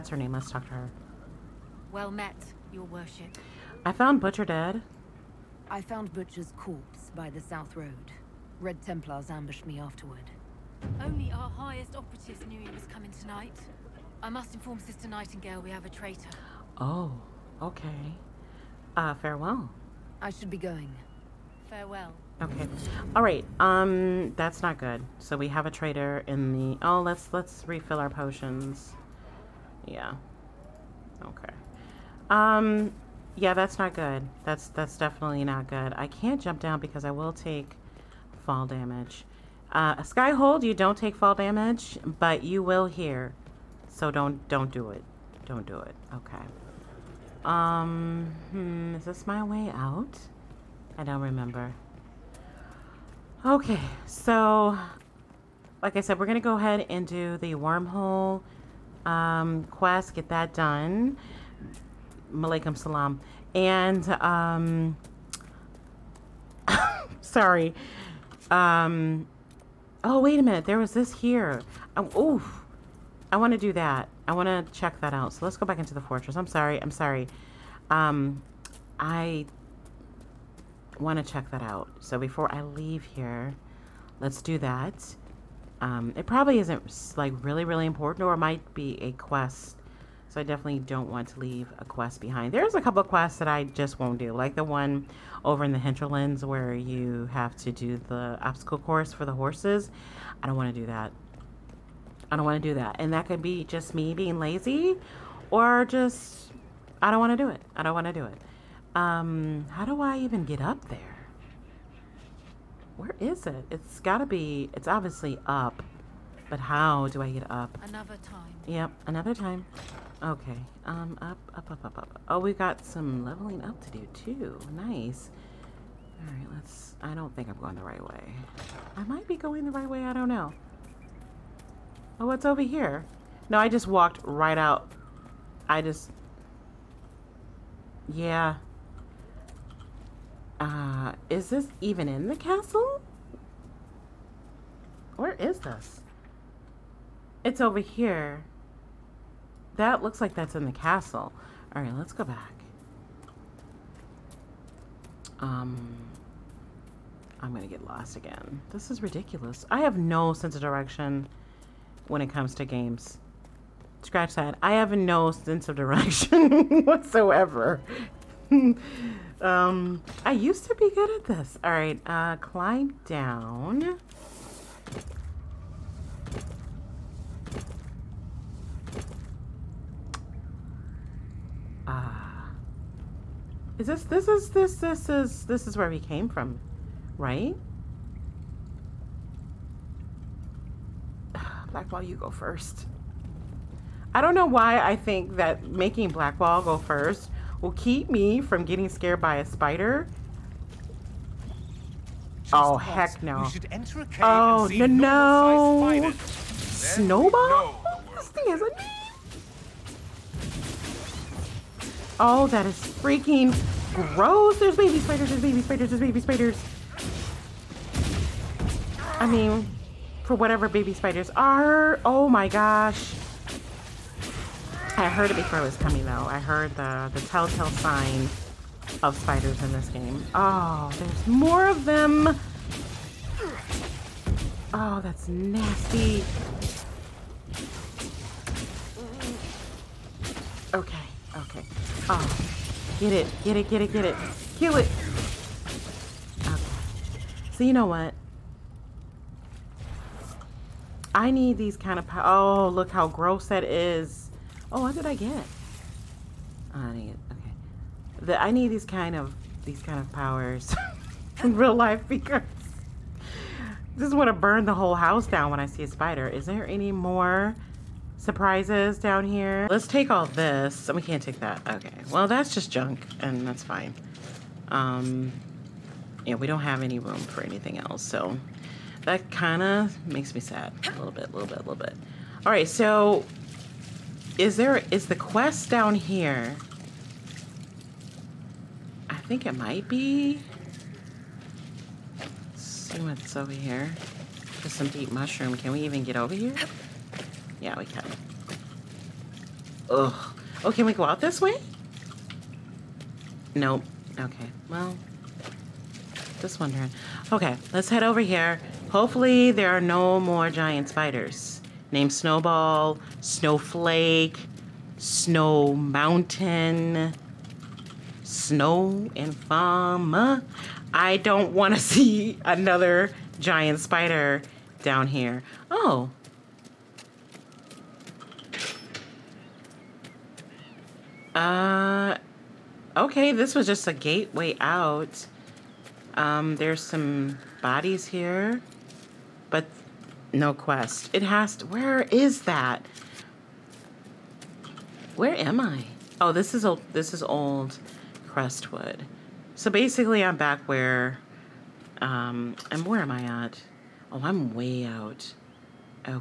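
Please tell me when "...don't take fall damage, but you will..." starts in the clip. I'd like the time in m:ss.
0:40.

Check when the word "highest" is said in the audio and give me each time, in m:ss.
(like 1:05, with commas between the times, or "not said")
0:11.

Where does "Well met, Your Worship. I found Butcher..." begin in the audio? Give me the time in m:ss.
0:01.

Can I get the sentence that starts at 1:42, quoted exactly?
And that could be just me being lazy or just, I don't want to do it.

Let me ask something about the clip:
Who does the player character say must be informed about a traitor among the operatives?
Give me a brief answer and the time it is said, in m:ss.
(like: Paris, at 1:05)
Sister Nightingale, at 0:14.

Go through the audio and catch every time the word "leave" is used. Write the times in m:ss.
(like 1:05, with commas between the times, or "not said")
1:22, 1:31.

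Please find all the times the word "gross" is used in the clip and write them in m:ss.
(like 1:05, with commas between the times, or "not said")
3:34, 4:13.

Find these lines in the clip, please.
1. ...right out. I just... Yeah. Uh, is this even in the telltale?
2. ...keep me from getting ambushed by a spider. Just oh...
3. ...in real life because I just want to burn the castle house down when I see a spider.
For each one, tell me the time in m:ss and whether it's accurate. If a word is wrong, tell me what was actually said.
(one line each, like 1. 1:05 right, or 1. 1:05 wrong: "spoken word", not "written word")
1. 2:14 wrong: "castle", not "telltale"
2. 3:17 wrong: "scared", not "ambushed"
3. 4:21 wrong: "whole", not "castle".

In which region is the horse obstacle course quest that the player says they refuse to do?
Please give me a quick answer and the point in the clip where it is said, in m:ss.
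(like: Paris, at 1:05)
the Hinterlands, at 1:35.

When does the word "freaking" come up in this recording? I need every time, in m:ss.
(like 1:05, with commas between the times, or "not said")
3:32.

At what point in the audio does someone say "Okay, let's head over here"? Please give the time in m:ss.
5:07.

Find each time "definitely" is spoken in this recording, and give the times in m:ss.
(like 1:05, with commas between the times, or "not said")
0:34, 1:30.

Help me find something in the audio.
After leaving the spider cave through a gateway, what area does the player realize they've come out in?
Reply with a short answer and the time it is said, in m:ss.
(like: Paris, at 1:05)
old Crestwood, at 5:47.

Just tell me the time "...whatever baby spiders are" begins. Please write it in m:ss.
3:40.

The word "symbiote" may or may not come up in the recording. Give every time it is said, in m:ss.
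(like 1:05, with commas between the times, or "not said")
not said.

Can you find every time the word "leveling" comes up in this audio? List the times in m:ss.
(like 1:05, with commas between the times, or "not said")
2:03.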